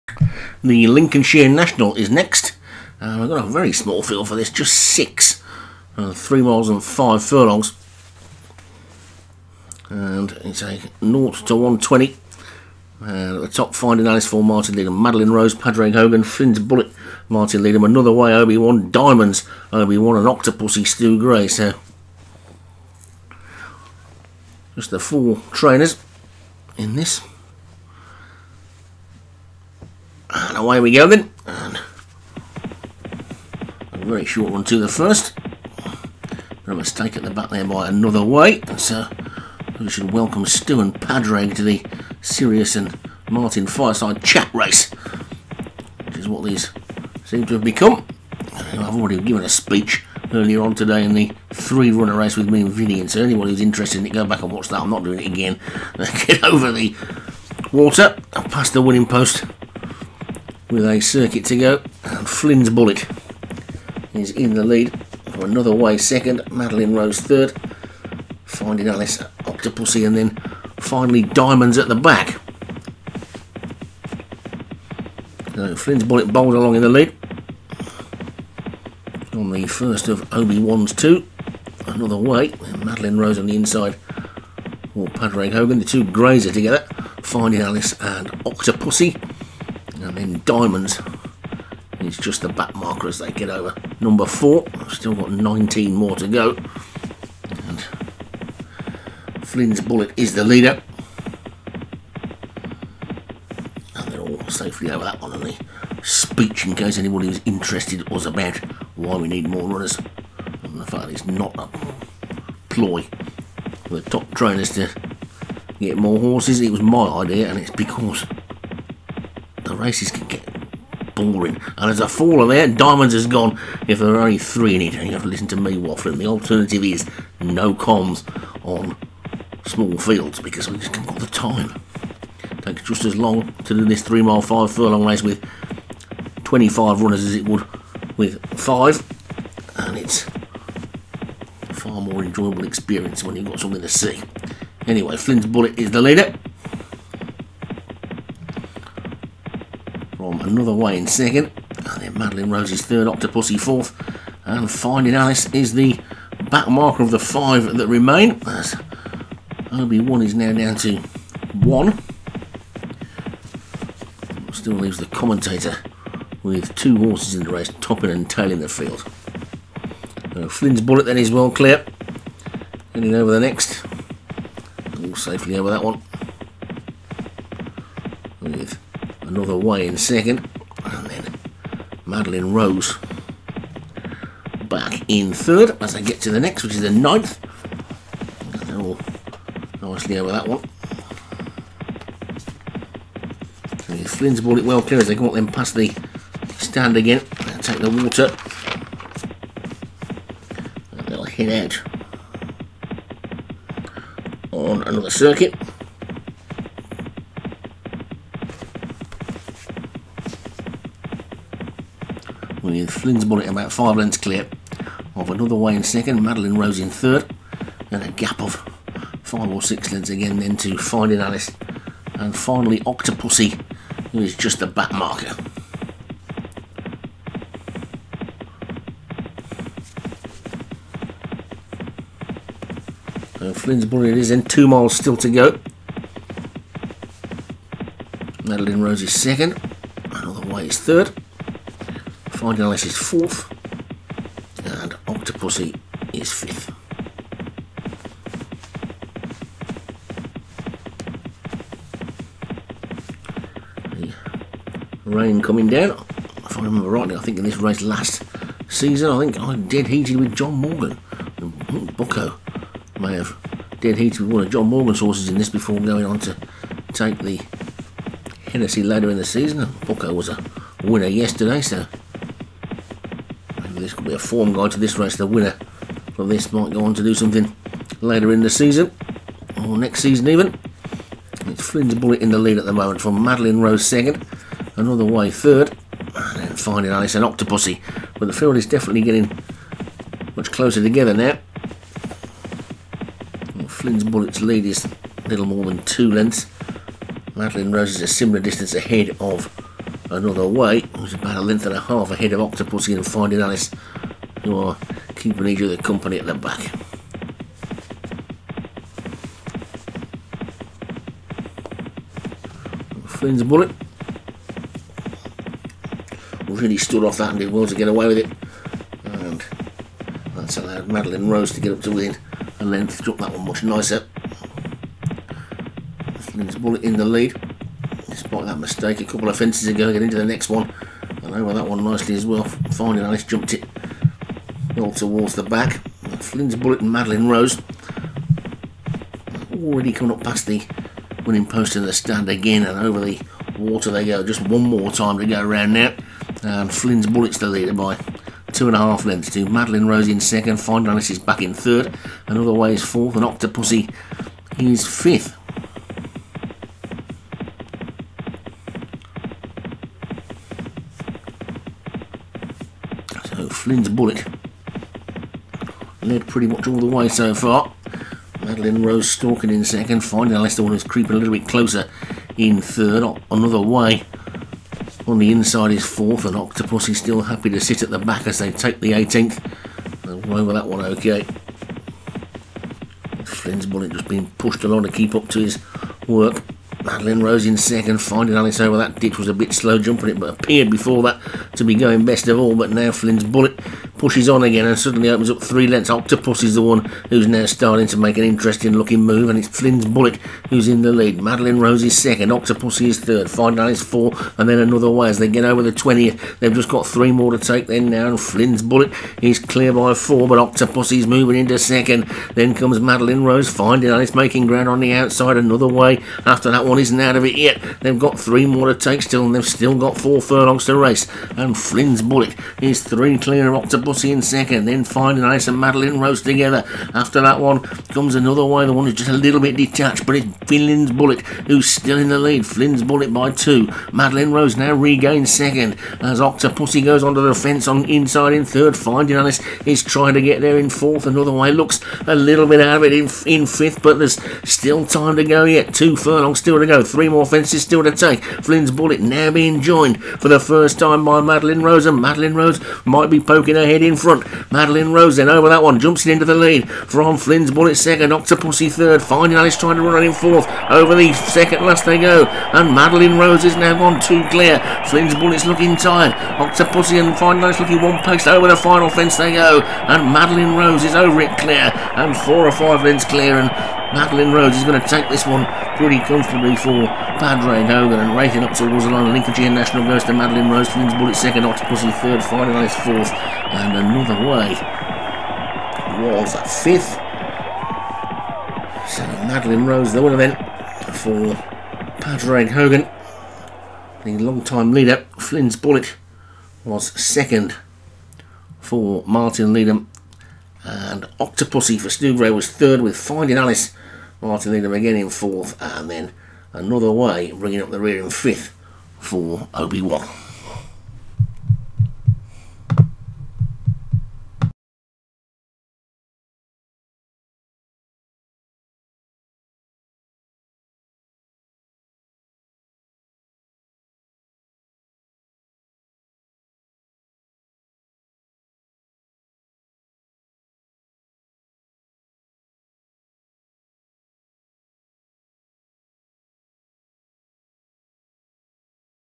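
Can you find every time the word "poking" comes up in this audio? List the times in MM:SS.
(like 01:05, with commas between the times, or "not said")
07:33.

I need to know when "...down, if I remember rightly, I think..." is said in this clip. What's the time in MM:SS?
04:15.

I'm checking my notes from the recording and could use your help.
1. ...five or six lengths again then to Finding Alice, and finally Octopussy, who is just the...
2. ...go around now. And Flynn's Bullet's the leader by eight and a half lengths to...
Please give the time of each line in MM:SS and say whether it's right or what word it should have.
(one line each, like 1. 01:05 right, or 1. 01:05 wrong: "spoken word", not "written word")
1. 03:39 right
2. 05:45 wrong: "two", not "eight".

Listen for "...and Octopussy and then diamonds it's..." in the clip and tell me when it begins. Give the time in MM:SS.
01:28.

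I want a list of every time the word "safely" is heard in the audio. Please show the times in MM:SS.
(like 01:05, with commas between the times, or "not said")
01:44, 02:55.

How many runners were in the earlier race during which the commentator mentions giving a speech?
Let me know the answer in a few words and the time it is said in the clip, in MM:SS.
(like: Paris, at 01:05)
3, at 00:51.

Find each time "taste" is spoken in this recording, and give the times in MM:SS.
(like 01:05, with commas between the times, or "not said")
not said.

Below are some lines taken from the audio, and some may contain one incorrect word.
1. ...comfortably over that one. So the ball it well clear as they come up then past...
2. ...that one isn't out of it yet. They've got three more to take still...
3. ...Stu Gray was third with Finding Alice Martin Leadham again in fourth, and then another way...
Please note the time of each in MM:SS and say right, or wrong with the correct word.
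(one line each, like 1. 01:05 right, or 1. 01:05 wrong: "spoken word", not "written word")
1. 03:09 wrong: "nicely", not "comfortably"
2. 06:56 right
3. 08:21 right.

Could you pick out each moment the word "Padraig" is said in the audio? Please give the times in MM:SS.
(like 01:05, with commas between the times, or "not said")
00:15, 00:40, 01:25, 07:57, 08:11.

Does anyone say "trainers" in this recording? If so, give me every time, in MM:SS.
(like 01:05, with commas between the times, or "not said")
00:25, 01:54.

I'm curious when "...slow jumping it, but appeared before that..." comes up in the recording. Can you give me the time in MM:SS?
06:29.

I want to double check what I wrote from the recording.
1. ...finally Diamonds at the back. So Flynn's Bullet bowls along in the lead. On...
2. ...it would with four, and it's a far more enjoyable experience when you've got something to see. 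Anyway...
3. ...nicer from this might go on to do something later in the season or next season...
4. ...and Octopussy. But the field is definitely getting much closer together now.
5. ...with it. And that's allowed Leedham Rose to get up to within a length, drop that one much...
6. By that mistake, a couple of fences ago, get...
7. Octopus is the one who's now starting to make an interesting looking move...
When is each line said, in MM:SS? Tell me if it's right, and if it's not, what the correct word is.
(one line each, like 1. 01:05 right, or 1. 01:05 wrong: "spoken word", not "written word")
1. 01:10 right
2. 02:17 wrong: "five", not "four"
3. 04:35 wrong: "winner", not "nicer"
4. 04:47 right
5. 05:18 wrong: "Madeline", not "Leedham"
6. 05:28 right
7. 06:35 right.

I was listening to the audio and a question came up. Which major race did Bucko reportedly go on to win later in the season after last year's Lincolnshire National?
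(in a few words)
the Hennessy.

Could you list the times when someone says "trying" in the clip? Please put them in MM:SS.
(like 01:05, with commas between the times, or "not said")
07:19, 07:39.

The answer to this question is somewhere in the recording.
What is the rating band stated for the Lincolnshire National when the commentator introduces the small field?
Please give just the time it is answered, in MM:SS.
00:11.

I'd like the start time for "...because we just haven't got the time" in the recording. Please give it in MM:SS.
02:10.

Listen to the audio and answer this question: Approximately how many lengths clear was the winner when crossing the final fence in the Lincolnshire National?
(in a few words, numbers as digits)
4 or 5 lengths.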